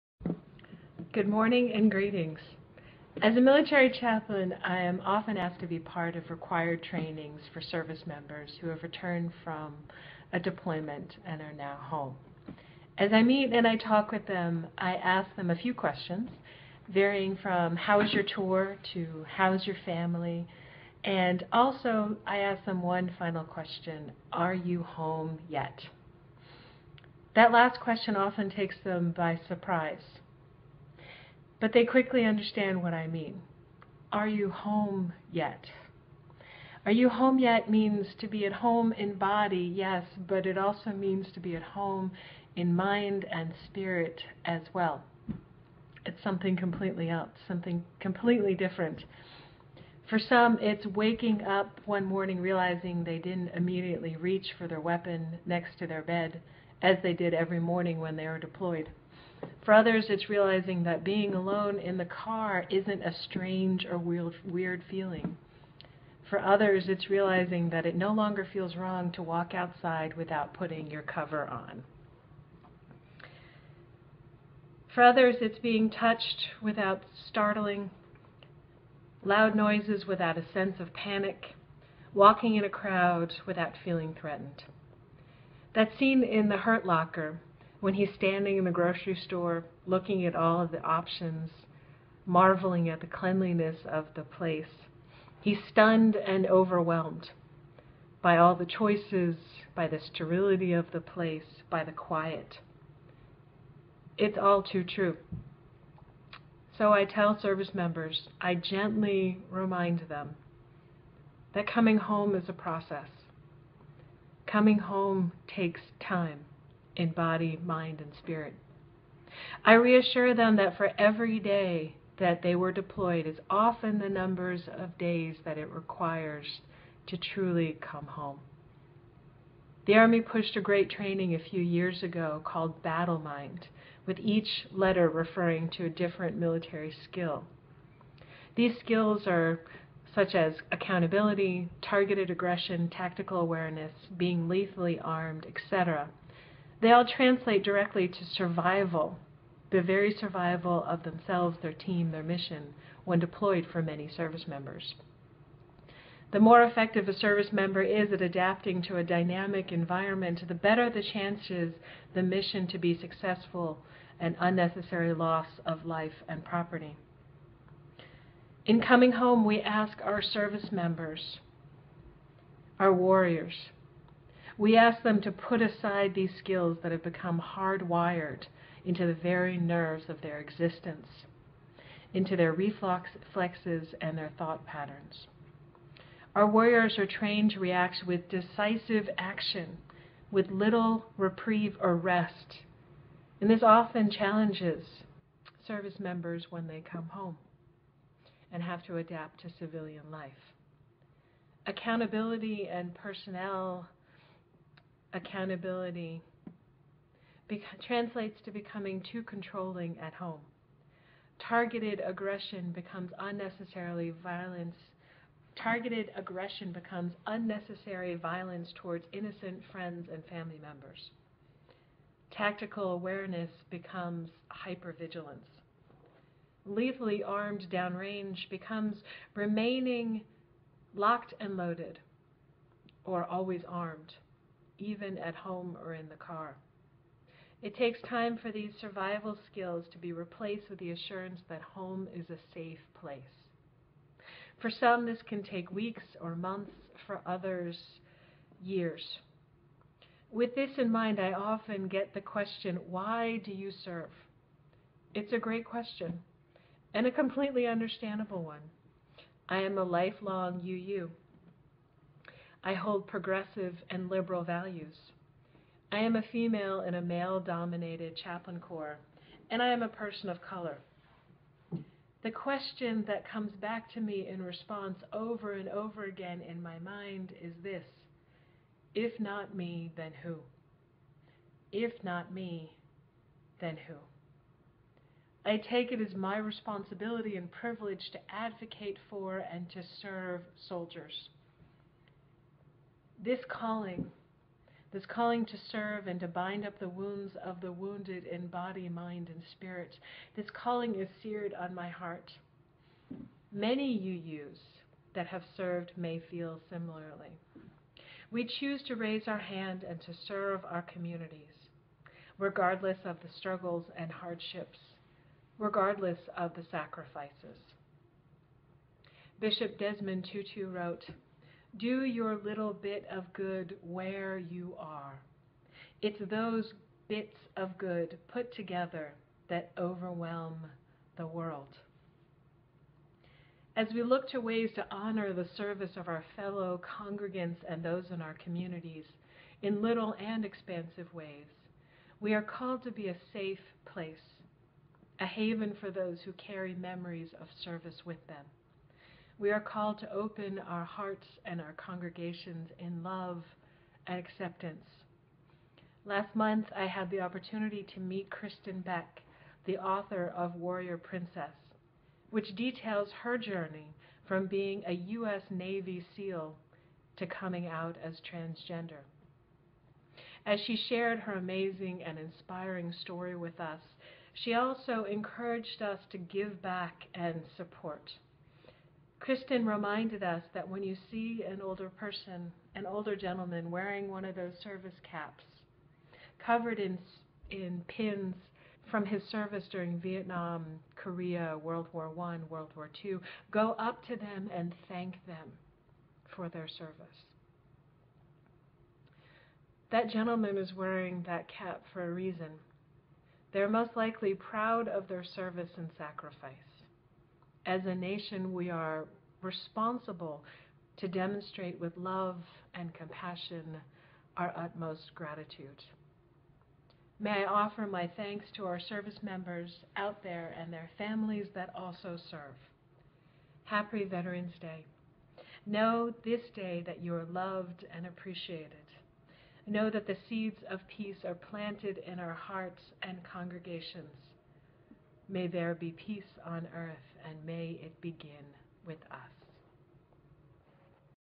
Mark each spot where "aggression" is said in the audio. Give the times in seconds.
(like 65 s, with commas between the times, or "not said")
142 s, 212 s, 216 s.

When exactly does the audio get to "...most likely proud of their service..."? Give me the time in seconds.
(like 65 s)
403 s.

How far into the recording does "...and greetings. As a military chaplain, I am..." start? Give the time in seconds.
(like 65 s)
1 s.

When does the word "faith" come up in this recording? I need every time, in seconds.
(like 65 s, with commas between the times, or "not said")
not said.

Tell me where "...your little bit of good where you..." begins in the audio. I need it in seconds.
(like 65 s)
322 s.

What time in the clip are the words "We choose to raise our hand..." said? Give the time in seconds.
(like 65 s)
308 s.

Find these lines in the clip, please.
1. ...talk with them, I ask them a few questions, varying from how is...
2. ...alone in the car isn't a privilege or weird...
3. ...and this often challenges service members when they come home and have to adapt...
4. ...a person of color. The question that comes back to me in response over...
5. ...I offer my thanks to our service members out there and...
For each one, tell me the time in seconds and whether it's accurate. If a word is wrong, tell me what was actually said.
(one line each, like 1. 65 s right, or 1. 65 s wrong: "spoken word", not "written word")
1. 13 s right
2. 61 s wrong: "strange", not "privilege"
3. 193 s right
4. 269 s right
5. 417 s right.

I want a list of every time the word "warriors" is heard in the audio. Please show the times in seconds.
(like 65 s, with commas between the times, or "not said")
172 s, 186 s, 360 s.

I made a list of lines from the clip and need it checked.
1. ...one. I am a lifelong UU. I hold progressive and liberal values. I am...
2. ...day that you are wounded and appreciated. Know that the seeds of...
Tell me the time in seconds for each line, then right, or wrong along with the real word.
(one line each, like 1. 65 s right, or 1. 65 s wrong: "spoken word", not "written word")
1. 258 s right
2. 426 s wrong: "loved", not "wounded".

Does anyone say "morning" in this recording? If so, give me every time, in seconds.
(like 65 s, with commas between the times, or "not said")
1 s, 52 s, 57 s.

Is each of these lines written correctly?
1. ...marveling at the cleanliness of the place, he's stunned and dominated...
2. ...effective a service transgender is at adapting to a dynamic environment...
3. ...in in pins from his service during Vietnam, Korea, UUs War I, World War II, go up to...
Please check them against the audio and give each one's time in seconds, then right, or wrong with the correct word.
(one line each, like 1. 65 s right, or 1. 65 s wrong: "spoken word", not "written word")
1. 92 s wrong: "overwhelmed", not "dominated"
2. 156 s wrong: "member", not "transgender"
3. 386 s wrong: "World", not "UUs".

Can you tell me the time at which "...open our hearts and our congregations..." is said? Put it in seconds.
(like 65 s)
350 s.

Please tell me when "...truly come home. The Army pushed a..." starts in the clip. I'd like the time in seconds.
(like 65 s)
127 s.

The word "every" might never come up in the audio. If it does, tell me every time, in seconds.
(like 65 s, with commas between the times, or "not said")
57 s, 120 s.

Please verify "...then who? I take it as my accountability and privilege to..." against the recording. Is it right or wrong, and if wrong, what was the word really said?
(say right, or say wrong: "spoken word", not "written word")
wrong: "responsibility", not "accountability".